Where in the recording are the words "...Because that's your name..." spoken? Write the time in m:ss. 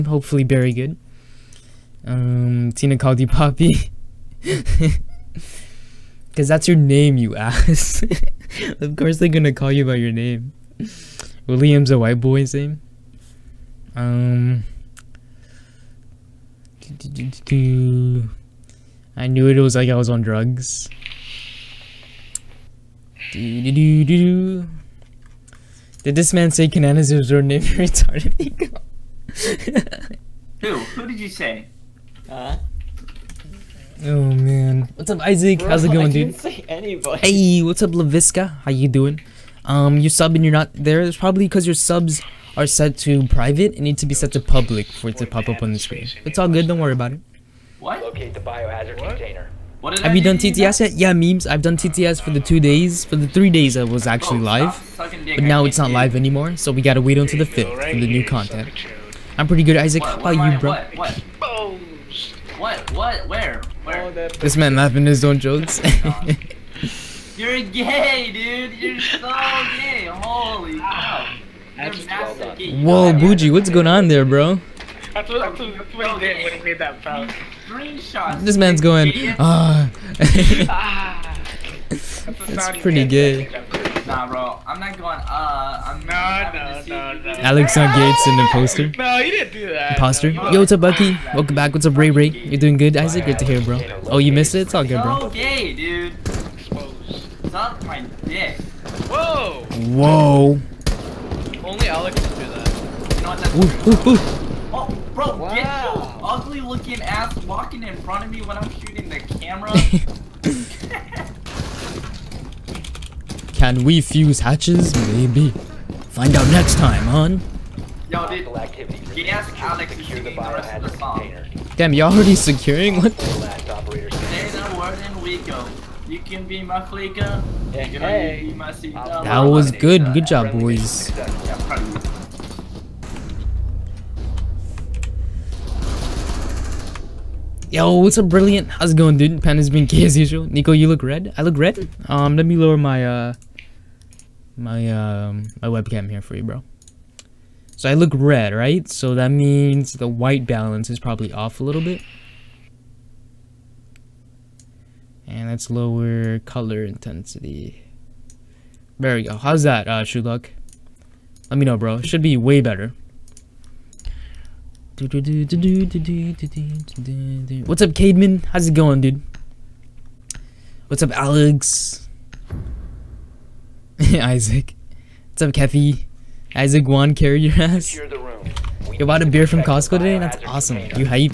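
0:06.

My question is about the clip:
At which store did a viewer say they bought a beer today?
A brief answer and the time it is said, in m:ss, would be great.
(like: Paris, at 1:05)
Costco, at 2:59.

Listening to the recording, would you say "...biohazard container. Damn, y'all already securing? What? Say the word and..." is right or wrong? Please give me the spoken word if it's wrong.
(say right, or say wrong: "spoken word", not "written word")
right.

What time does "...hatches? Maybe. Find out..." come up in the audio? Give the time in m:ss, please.
1:54.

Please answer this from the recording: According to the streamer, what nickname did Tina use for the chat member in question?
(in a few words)
Poppy.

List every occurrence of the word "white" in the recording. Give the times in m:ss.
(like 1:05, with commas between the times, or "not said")
0:11, 2:30.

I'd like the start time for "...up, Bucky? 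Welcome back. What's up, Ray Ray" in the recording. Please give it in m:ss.
1:30.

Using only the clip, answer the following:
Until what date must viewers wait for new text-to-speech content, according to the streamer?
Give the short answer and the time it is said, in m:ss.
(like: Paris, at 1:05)
the 5th, at 0:57.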